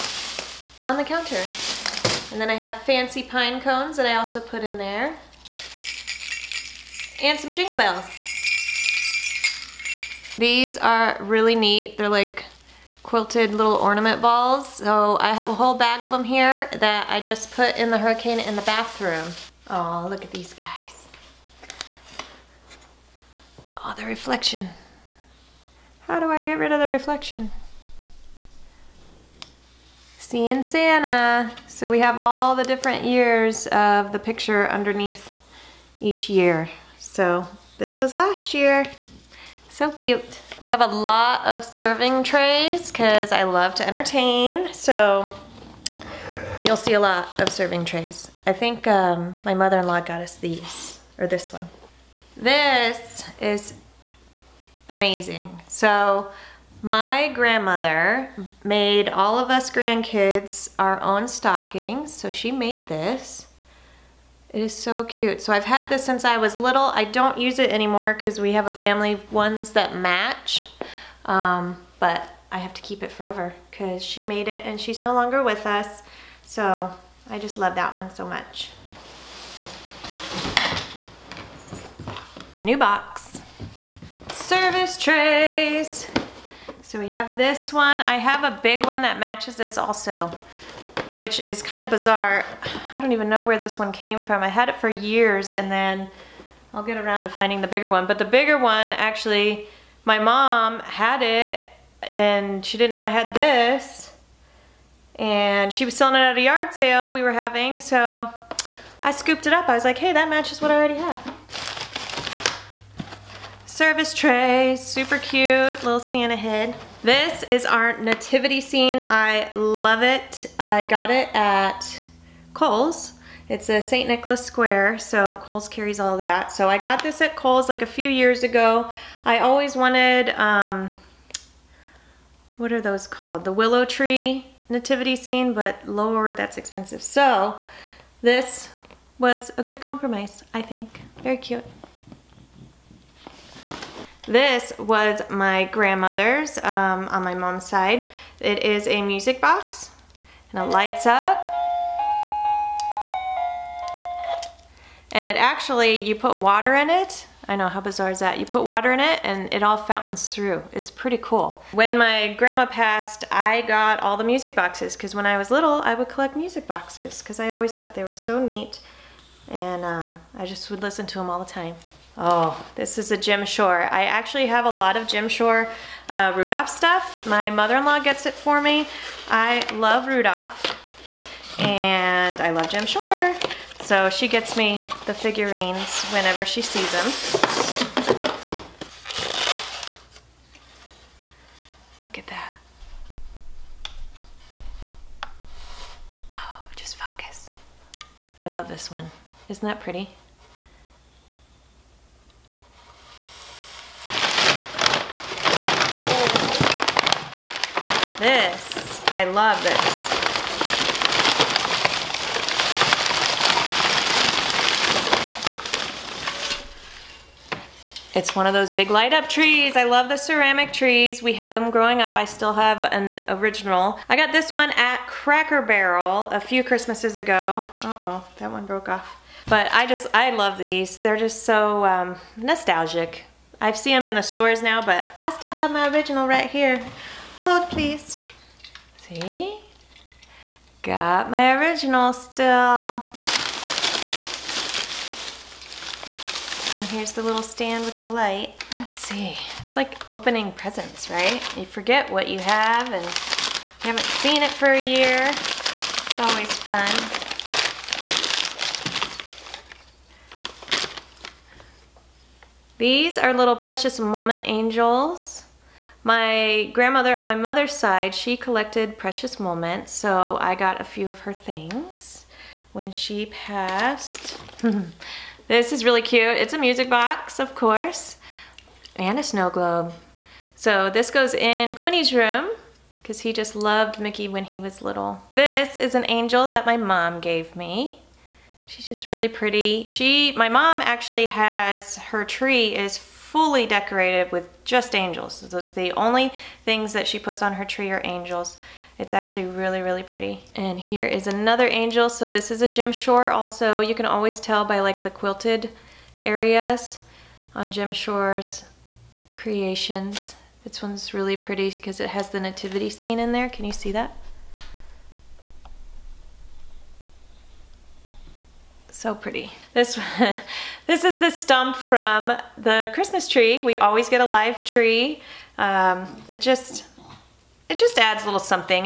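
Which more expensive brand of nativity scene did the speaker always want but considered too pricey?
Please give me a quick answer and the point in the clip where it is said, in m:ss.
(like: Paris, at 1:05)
Willow Tree, at 2:13.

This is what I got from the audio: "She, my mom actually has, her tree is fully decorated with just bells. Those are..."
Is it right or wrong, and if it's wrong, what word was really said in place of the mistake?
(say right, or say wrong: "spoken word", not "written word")
wrong: "angels", not "bells".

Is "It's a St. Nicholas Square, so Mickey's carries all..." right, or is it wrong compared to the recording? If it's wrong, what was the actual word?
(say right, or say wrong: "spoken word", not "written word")
wrong: "Kohl", not "Mickey".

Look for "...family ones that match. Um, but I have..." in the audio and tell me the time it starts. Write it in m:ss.
1:08.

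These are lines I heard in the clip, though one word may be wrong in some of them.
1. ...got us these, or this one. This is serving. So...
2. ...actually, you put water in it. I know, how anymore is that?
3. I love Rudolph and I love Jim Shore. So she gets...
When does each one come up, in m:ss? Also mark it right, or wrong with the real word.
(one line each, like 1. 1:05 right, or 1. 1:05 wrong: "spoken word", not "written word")
1. 0:50 wrong: "amazing", not "serving"
2. 2:35 wrong: "bizarre", not "anymore"
3. 2:59 right.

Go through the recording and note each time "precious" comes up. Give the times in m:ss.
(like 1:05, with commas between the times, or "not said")
4:23, 4:28.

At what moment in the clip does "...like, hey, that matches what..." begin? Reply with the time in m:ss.
1:49.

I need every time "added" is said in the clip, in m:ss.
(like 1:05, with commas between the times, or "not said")
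not said.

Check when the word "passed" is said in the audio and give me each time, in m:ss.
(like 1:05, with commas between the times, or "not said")
2:42, 4:33.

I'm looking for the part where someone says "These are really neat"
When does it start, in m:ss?
0:10.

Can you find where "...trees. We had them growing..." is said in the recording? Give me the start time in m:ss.
3:40.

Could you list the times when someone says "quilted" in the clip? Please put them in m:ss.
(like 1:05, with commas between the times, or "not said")
0:13, 5:05.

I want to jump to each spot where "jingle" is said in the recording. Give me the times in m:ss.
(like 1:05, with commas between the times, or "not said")
0:07.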